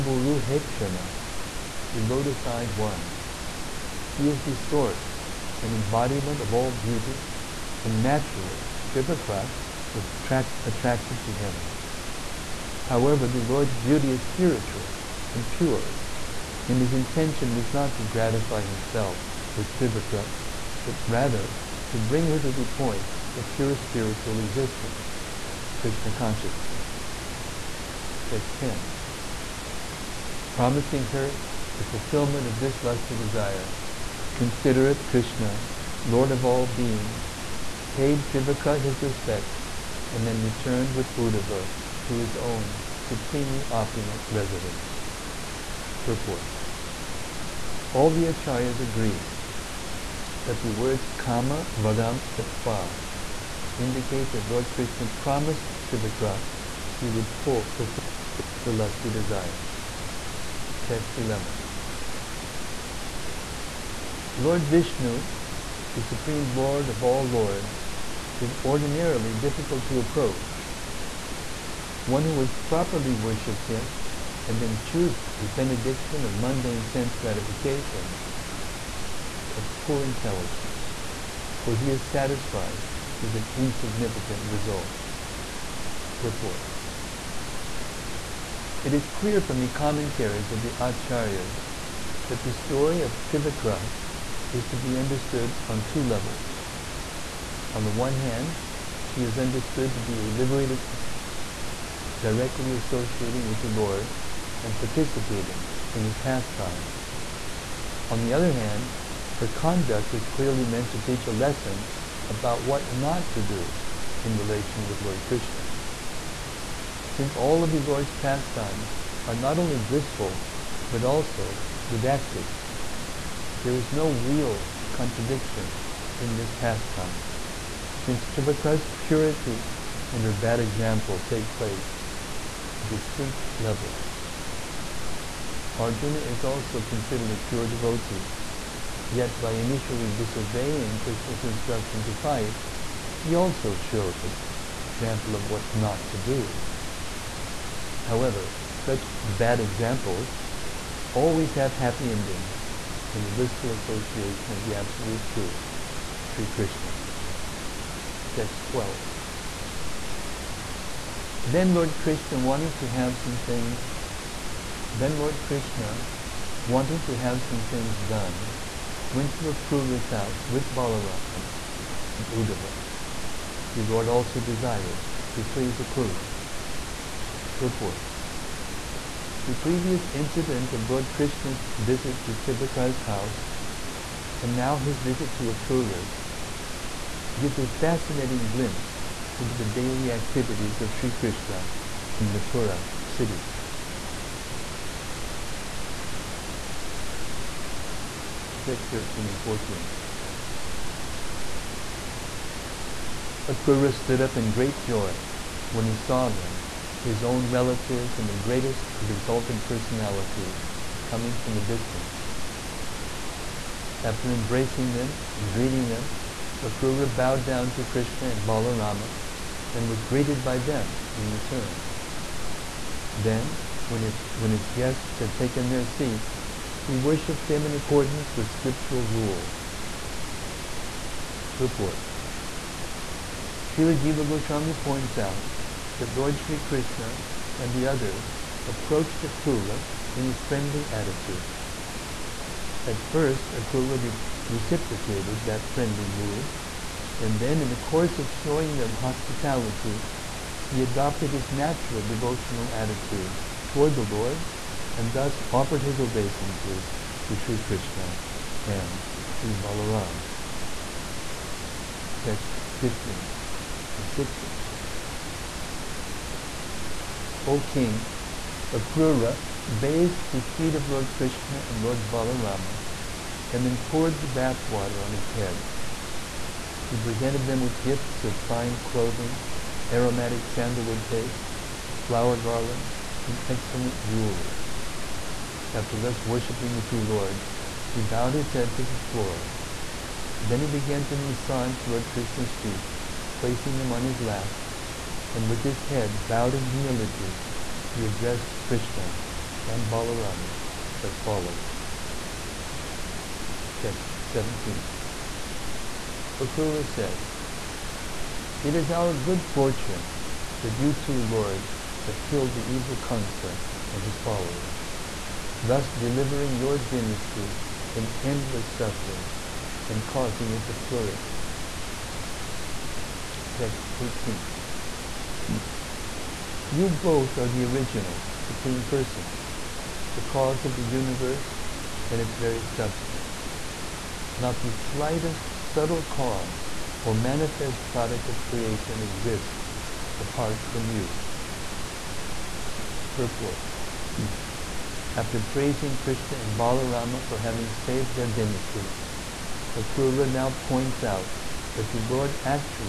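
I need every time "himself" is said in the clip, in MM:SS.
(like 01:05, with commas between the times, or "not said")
00:18.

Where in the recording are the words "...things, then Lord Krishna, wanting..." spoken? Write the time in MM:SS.
02:43.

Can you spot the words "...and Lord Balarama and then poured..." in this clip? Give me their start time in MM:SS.
04:31.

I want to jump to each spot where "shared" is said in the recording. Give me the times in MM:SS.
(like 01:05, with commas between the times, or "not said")
not said.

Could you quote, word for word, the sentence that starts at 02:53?
The Lord also desired to please Akrura.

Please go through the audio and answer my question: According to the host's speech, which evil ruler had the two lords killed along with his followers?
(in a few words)
Kansa.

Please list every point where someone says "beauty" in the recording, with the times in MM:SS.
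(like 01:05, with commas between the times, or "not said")
00:06, 00:13.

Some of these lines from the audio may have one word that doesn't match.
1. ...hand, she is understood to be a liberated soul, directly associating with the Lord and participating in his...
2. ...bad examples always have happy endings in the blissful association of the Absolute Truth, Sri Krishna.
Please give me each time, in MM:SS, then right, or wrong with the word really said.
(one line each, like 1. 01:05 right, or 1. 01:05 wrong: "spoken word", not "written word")
1. 01:38 right
2. 02:29 right.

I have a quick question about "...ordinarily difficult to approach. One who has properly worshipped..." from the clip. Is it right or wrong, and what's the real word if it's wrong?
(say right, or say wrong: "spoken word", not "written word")
right.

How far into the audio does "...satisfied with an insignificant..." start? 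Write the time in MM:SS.
01:22.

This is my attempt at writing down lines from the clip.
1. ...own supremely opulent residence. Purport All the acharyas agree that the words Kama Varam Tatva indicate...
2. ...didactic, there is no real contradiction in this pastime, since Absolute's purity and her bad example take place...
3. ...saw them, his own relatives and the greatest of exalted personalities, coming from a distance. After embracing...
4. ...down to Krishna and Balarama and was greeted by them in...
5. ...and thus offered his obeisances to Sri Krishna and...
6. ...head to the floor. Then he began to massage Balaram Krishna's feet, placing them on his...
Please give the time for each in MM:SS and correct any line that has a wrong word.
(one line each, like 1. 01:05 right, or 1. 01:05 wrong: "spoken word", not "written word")
1. 00:42 right
2. 02:01 wrong: "Trivakra", not "Absolute"
3. 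03:25 right
4. 03:37 right
5. 04:14 right
6. 04:48 wrong: "Lord", not "Balaram".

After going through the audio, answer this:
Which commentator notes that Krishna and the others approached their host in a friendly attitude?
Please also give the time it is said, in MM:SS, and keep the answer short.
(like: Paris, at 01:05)
Srila Jiva Goswami, at 03:53.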